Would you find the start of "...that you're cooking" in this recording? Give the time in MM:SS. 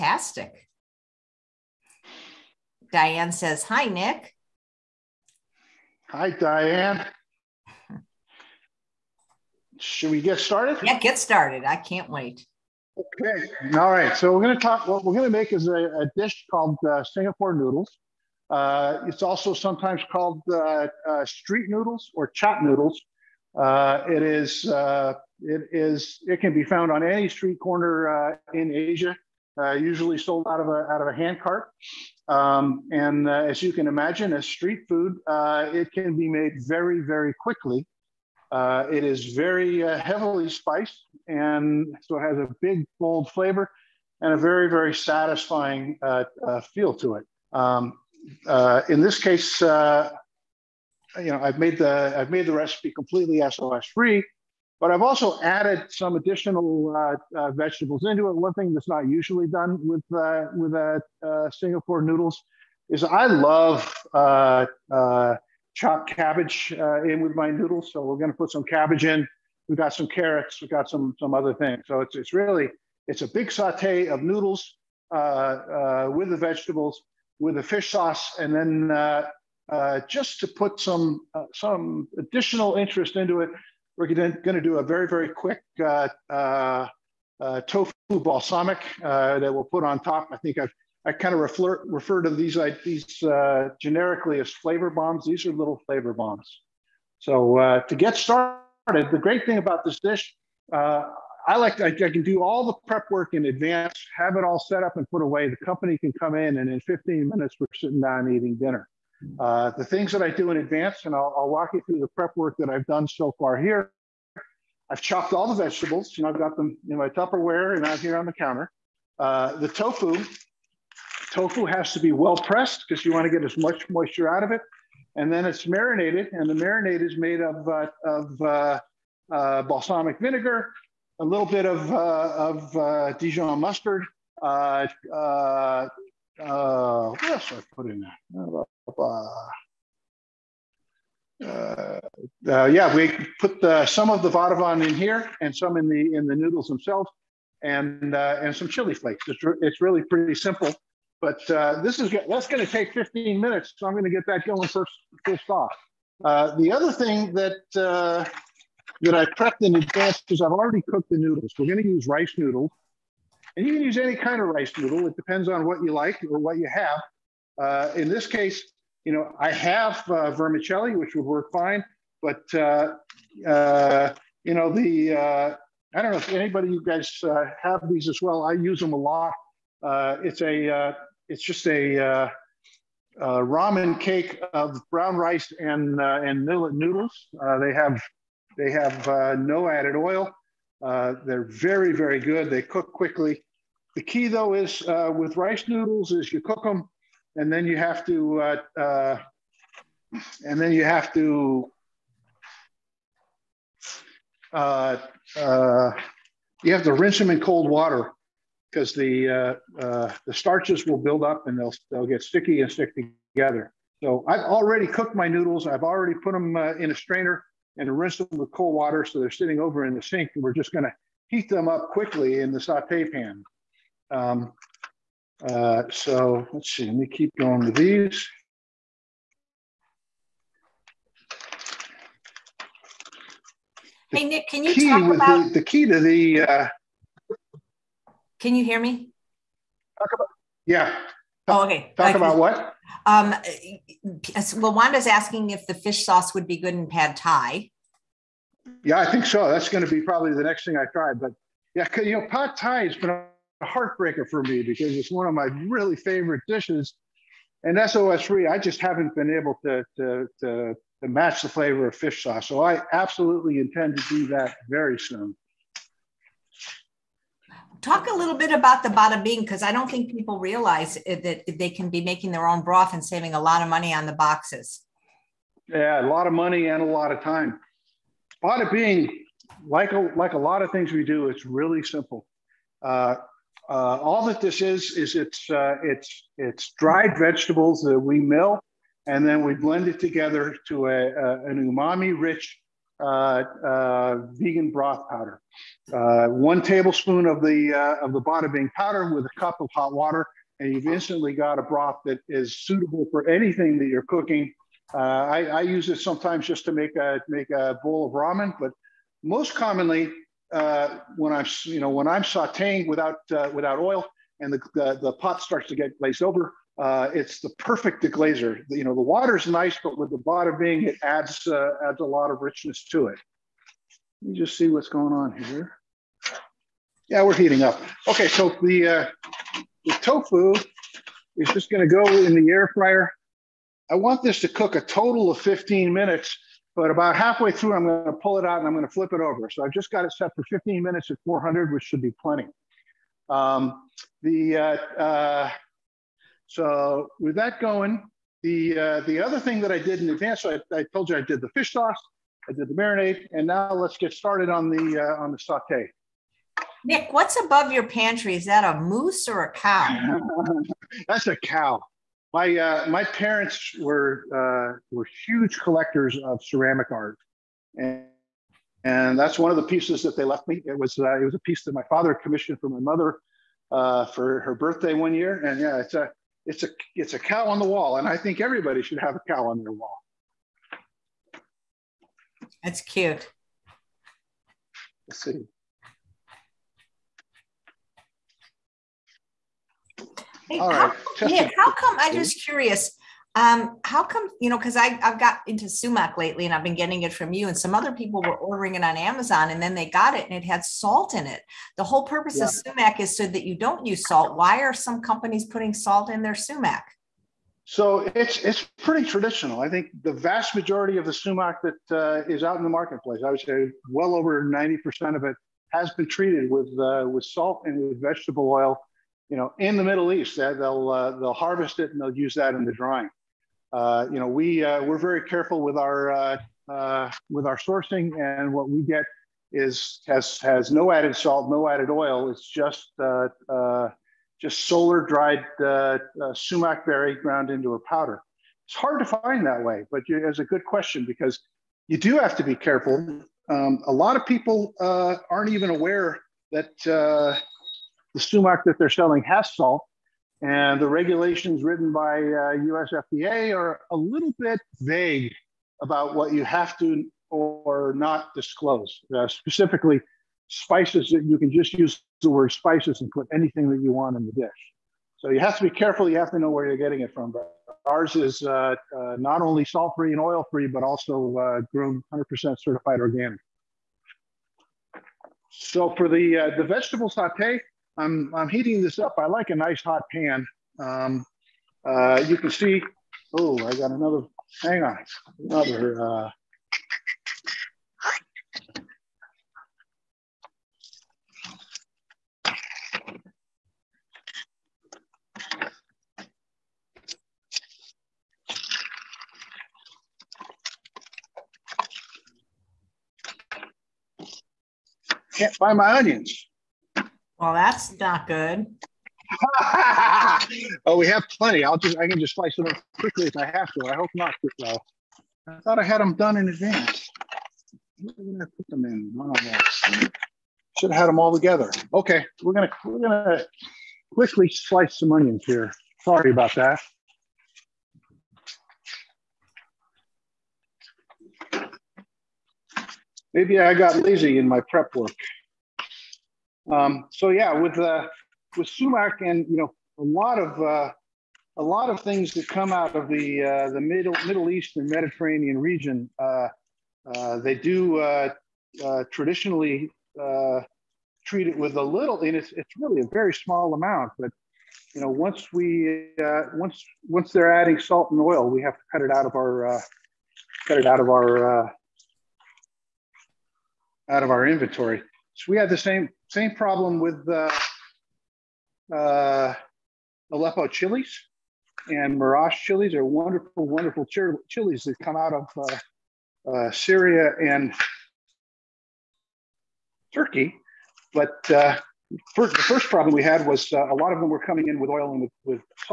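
05:03.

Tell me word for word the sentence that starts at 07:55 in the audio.
So for the uh, the vegetable saute, I'm, I'm heating this up.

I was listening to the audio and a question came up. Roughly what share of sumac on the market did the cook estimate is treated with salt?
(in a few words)
over 90%.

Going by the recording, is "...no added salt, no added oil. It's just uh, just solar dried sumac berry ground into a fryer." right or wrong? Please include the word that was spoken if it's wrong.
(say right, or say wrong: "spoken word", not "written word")
wrong: "powder", not "fryer".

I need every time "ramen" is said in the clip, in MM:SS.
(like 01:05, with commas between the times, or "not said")
03:03, 05:08.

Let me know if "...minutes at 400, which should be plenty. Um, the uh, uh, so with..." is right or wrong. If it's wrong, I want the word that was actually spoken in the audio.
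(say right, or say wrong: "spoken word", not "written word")
right.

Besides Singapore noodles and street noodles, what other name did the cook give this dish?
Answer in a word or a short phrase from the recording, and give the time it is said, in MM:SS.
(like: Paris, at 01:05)
chop noodles, at 00:22.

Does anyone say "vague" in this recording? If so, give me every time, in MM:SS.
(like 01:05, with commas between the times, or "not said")
07:34.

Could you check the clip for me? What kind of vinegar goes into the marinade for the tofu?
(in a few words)
balsamic vinegar.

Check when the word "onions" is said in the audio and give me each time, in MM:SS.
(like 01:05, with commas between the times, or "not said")
08:25, 08:45.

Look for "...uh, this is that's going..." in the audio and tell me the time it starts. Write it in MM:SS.
02:31.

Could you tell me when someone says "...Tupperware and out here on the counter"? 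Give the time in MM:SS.
01:57.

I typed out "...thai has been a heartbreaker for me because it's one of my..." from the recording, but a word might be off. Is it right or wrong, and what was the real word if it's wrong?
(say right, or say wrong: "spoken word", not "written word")
right.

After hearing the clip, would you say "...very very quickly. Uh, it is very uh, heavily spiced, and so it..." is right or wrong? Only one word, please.
right.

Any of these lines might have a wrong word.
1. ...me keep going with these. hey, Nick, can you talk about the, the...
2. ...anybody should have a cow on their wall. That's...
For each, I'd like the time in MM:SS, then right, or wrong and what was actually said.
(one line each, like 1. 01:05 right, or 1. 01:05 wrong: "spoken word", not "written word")
1. 03:46 right
2. 06:18 wrong: "everybody", not "anybody".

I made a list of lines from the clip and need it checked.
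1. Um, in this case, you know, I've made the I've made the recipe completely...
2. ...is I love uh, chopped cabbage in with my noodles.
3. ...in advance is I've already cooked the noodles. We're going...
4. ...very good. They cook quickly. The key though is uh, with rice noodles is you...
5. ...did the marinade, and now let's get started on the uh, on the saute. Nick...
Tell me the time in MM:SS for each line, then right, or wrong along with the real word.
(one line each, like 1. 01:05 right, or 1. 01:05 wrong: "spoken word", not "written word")
1. 00:47 right
2. 01:02 right
3. 02:39 right
4. 03:11 right
5. 05:52 right.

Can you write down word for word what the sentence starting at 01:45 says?
The company can come in, and in 15 minutes we're sitting down eating dinner.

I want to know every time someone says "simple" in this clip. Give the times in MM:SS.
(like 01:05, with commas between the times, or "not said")
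02:30, 04:41.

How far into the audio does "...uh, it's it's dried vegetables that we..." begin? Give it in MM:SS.
04:45.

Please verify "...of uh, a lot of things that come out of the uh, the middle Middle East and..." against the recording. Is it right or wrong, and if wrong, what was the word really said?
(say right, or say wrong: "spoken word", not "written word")
right.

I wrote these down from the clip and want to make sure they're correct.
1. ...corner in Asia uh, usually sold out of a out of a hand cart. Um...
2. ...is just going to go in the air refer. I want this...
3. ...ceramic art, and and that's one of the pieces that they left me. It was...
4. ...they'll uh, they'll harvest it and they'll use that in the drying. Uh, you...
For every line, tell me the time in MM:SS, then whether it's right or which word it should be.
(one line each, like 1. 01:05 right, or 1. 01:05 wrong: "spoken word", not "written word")
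1. 00:27 right
2. 05:31 wrong: "fryer", not "refer"
3. 06:06 right
4. 07:00 right.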